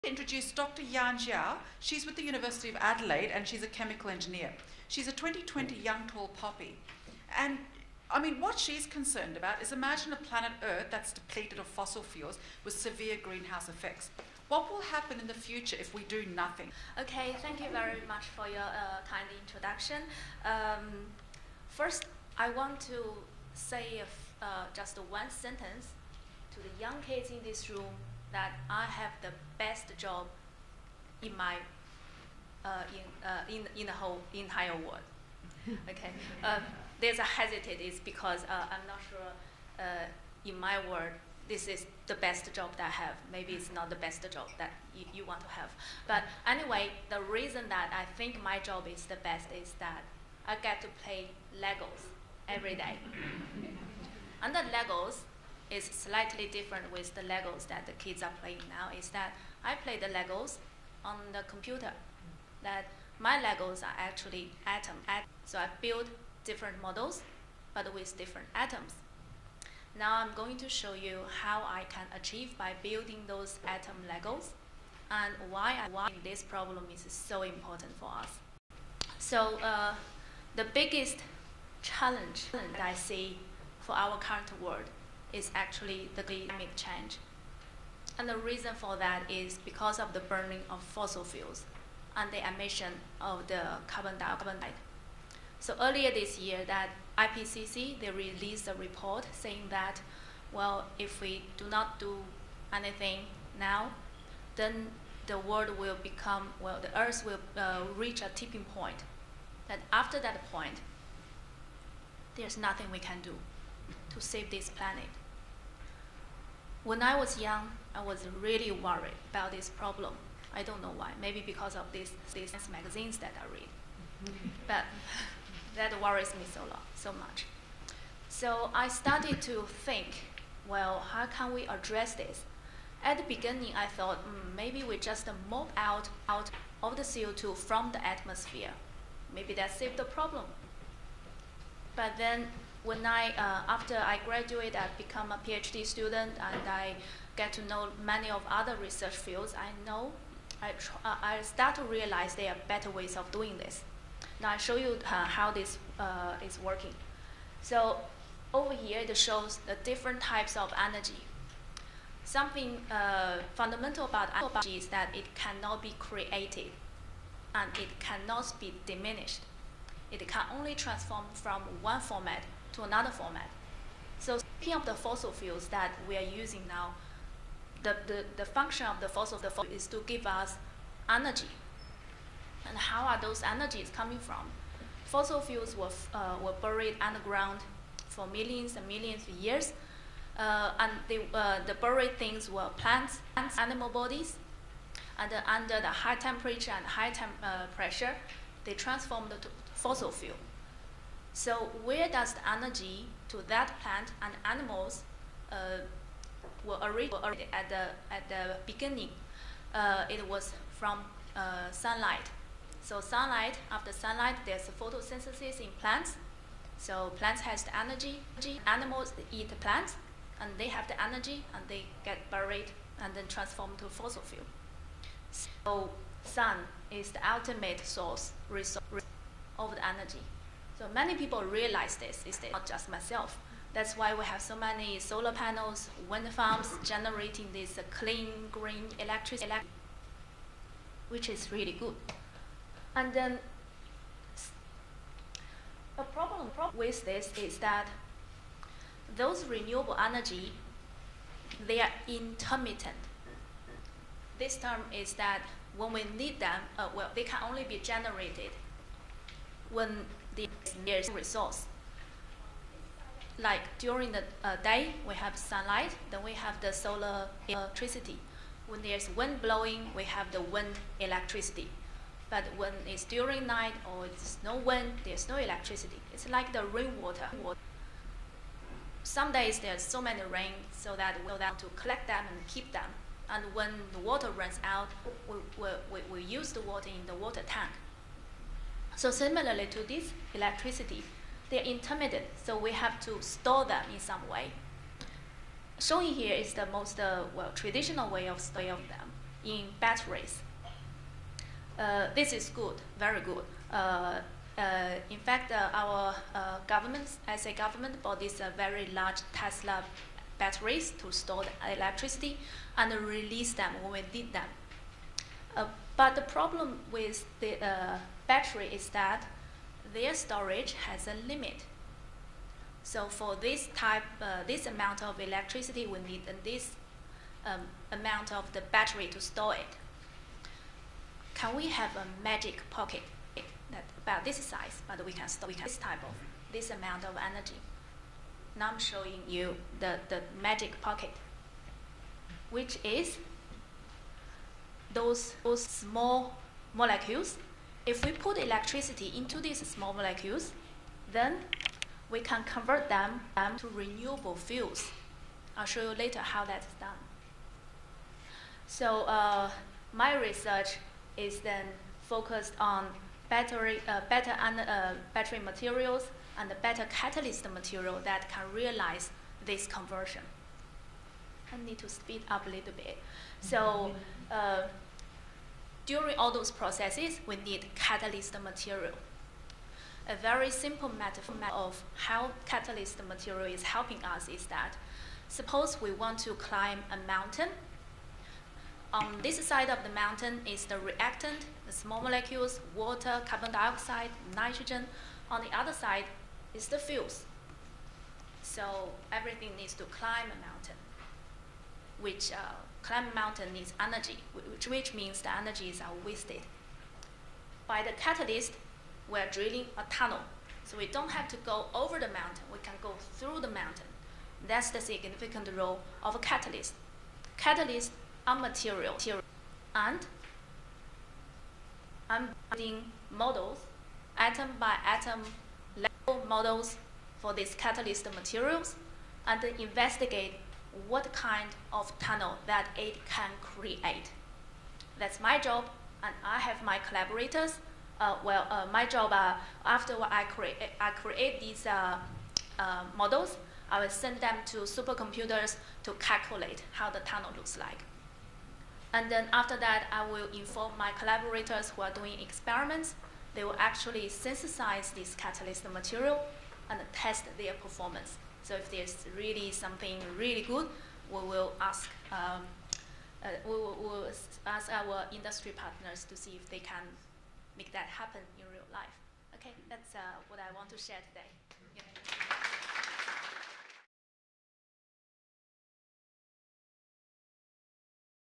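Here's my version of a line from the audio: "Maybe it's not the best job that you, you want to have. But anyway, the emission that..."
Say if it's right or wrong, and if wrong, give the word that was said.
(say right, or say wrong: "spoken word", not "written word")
wrong: "reason", not "emission".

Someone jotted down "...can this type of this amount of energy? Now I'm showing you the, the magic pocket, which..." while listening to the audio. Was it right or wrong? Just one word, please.
right.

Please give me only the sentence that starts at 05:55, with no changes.
I'll show you later how that is done.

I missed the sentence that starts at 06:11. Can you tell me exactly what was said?
I need to speed up a little bit.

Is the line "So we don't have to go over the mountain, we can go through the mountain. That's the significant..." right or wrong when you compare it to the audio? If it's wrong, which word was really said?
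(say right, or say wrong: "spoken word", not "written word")
right.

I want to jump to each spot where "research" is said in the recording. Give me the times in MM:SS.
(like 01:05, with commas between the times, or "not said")
02:28, 06:00.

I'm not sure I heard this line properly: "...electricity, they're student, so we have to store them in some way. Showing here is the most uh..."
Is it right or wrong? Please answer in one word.
wrong.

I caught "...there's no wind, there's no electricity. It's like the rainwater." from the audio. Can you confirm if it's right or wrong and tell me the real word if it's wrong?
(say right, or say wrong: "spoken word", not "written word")
right.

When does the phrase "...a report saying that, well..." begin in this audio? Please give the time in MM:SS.
01:38.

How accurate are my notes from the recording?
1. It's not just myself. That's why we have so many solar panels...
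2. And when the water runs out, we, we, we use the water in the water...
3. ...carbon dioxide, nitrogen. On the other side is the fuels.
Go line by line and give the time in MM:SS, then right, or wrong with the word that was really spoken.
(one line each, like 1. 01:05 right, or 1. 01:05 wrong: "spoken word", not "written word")
1. 03:52 right
2. 04:43 right
3. 06:33 right.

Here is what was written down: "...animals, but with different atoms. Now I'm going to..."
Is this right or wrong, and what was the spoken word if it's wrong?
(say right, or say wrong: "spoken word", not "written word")
wrong: "models", not "animals".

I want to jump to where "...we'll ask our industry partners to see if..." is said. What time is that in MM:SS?
07:43.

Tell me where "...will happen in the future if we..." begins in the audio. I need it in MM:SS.
00:14.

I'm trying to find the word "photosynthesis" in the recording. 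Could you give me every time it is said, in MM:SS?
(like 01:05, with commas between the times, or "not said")
03:34.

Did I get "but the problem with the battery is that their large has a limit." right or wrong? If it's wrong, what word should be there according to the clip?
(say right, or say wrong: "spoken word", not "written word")
wrong: "storage", not "large".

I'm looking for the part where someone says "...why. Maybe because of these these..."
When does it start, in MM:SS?
02:00.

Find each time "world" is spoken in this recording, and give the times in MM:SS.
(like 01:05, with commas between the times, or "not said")
00:34, 00:40, 01:24, 01:45.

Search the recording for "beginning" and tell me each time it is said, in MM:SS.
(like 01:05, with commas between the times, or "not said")
02:13, 03:28.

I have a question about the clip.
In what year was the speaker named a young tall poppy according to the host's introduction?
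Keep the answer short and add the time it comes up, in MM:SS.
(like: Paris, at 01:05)
2020, at 00:05.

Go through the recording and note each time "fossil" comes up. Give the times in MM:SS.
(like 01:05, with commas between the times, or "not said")
00:11, 01:30, 02:54, 02:59, 03:05, 03:19, 03:43.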